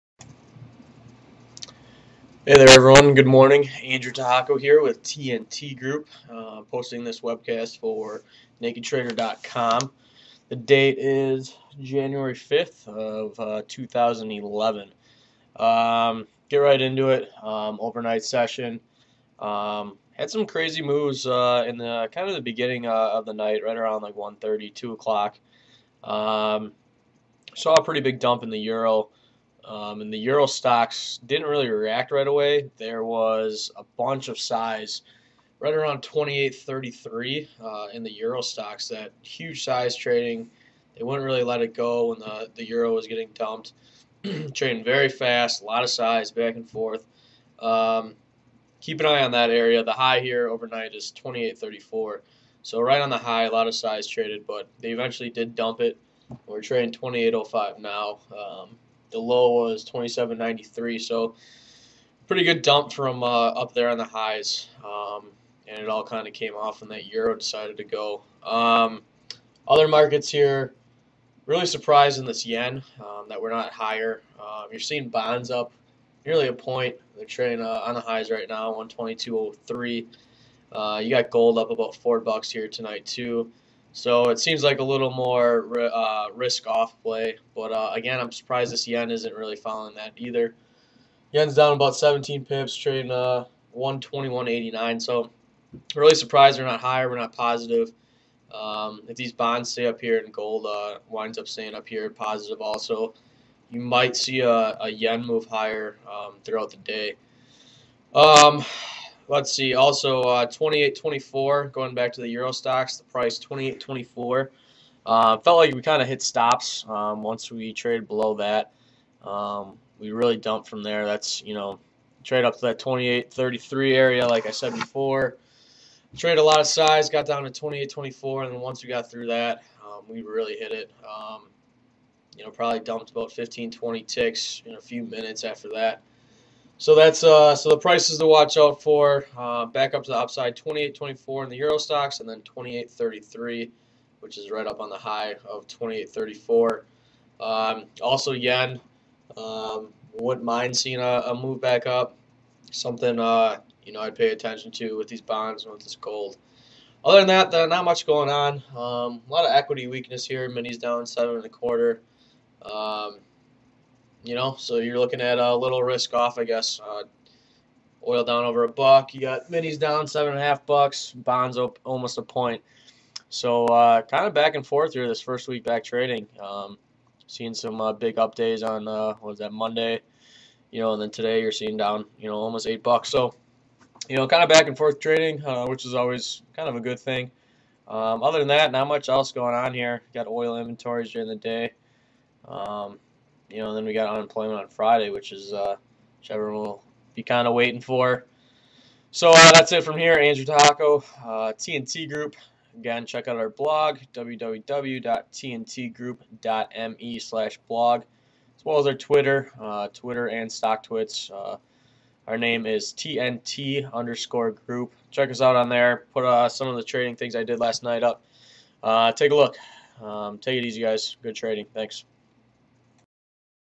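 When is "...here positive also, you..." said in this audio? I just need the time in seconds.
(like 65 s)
101 s.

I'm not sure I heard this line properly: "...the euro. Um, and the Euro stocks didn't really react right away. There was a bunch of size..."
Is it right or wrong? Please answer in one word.
right.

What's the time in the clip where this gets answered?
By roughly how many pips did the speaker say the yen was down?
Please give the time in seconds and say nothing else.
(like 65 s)
91 s.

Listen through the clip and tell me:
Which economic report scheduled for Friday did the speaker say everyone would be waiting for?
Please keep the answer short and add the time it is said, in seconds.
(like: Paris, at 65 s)
Unemployment, at 194 s.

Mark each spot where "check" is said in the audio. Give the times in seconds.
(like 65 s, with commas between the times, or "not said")
203 s, 215 s.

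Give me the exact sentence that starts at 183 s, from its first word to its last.
So, you know, kind of back and forth trading, uh, which is always kind of a good thing.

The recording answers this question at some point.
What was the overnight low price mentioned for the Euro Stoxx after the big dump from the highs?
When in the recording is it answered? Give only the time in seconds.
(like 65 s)
59 s.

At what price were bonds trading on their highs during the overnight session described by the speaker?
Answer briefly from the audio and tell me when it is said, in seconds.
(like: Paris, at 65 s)
122.03, at 78 s.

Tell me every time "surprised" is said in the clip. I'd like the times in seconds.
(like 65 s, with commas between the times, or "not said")
71 s, 88 s, 96 s.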